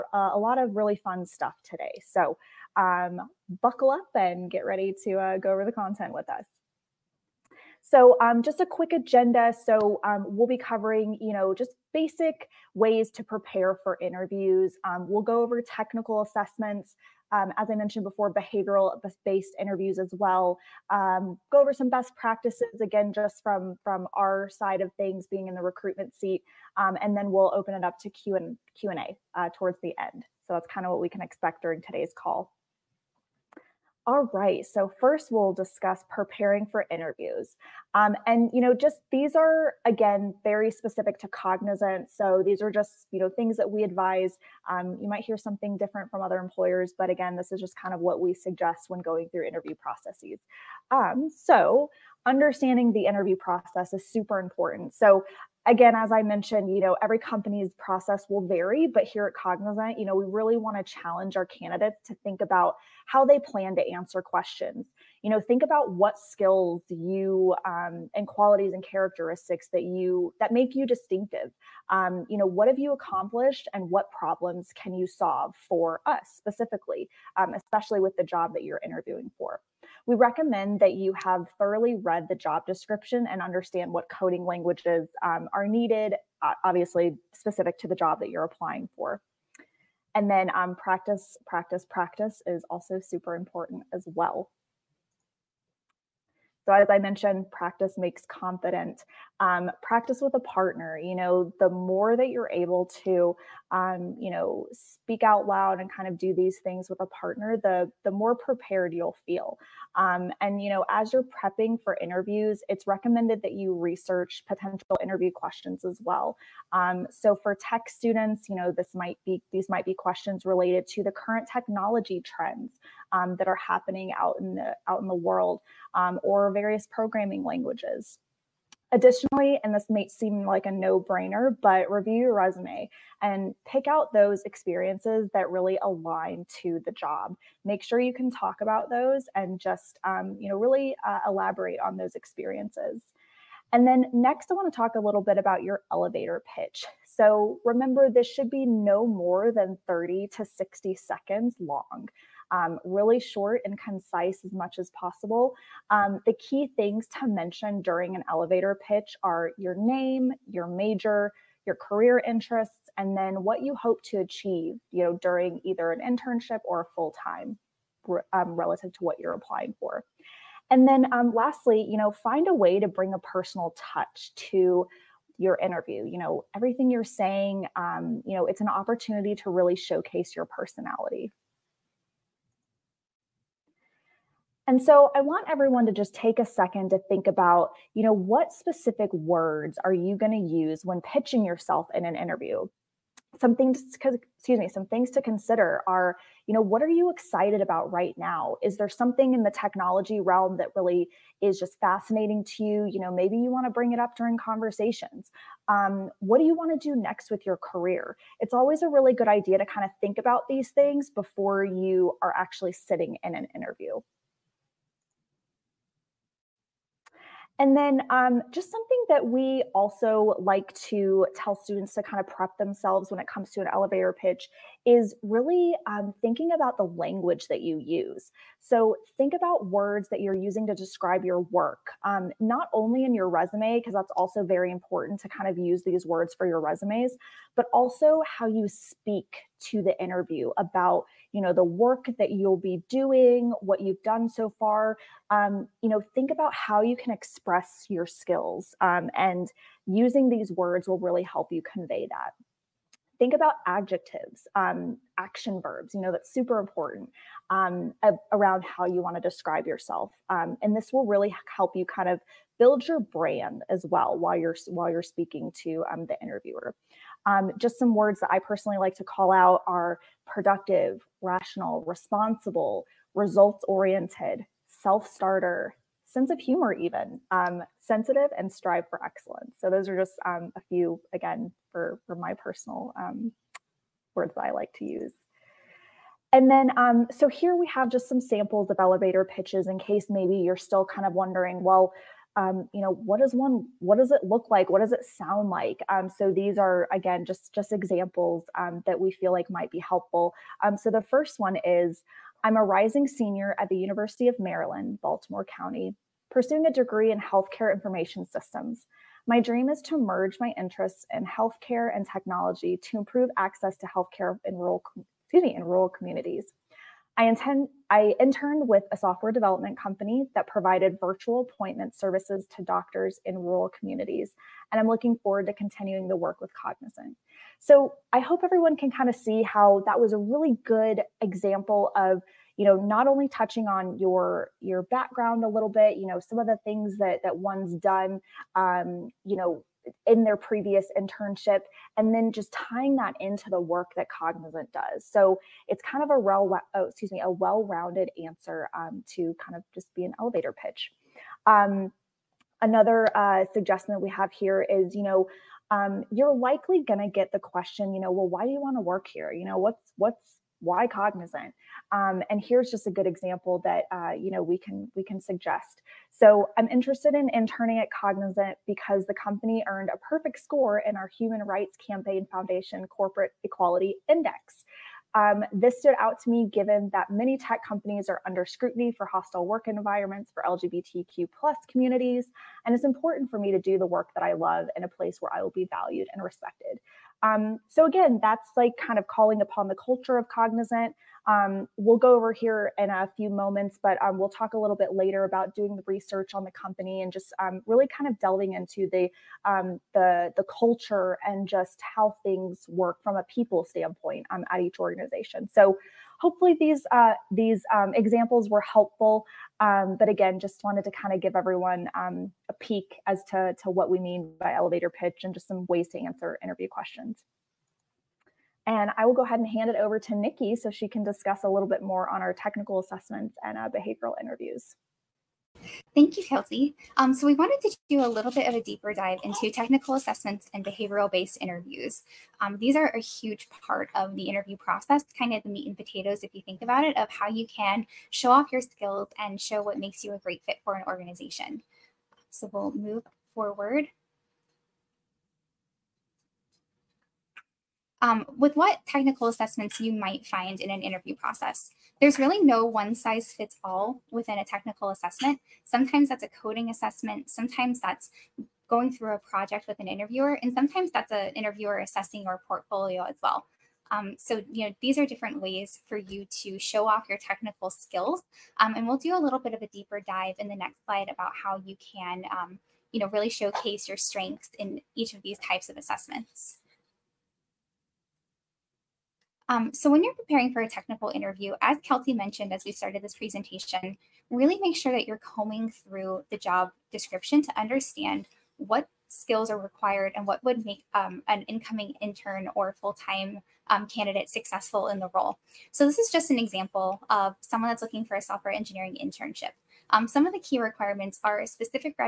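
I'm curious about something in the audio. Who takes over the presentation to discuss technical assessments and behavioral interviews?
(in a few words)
Nikki.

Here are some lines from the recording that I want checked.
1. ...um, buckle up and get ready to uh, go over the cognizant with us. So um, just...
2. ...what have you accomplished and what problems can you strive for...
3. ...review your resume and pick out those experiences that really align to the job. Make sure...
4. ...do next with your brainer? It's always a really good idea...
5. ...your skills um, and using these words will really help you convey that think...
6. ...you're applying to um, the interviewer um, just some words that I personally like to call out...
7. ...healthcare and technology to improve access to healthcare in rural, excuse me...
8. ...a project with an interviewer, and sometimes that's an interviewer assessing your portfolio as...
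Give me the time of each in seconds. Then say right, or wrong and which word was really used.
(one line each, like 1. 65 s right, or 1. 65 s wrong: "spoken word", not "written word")
1. 2 s wrong: "content", not "cognizant"
2. 72 s wrong: "solve", not "strive"
3. 131 s right
4. 206 s wrong: "career", not "brainer"
5. 247 s right
6. 264 s wrong: "speaking", not "applying"
7. 311 s right
8. 459 s right.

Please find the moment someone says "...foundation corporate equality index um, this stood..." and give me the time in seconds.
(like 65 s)
372 s.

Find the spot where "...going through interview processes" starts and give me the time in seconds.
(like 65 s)
49 s.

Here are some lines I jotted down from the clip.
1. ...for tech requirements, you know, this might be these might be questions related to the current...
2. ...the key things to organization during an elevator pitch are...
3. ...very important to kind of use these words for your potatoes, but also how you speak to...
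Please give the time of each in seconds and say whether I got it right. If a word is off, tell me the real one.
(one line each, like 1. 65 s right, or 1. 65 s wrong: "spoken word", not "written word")
1. 117 s wrong: "students", not "requirements"
2. 156 s wrong: "mention", not "organization"
3. 234 s wrong: "resumes", not "potatoes".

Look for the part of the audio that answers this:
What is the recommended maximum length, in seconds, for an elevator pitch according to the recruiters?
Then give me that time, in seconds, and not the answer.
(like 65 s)
150 s.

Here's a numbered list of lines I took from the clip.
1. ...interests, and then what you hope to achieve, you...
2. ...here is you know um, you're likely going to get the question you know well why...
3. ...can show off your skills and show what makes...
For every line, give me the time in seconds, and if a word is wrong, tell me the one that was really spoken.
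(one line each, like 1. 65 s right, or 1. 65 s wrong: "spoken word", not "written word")
1. 162 s right
2. 354 s right
3. 437 s right.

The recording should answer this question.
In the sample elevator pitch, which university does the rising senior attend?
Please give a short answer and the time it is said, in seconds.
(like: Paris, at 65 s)
University of Maryland, Baltimore County, at 303 s.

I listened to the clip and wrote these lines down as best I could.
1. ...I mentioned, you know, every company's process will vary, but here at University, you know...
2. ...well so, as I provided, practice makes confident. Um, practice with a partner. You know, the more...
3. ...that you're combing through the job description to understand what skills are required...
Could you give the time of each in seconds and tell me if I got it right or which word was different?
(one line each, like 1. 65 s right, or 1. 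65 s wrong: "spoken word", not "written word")
1. 56 s wrong: "Cognizant", not "University"
2. 94 s wrong: "mentioned", not "provided"
3. 484 s right.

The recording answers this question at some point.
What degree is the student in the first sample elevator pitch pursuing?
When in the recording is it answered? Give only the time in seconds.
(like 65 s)
307 s.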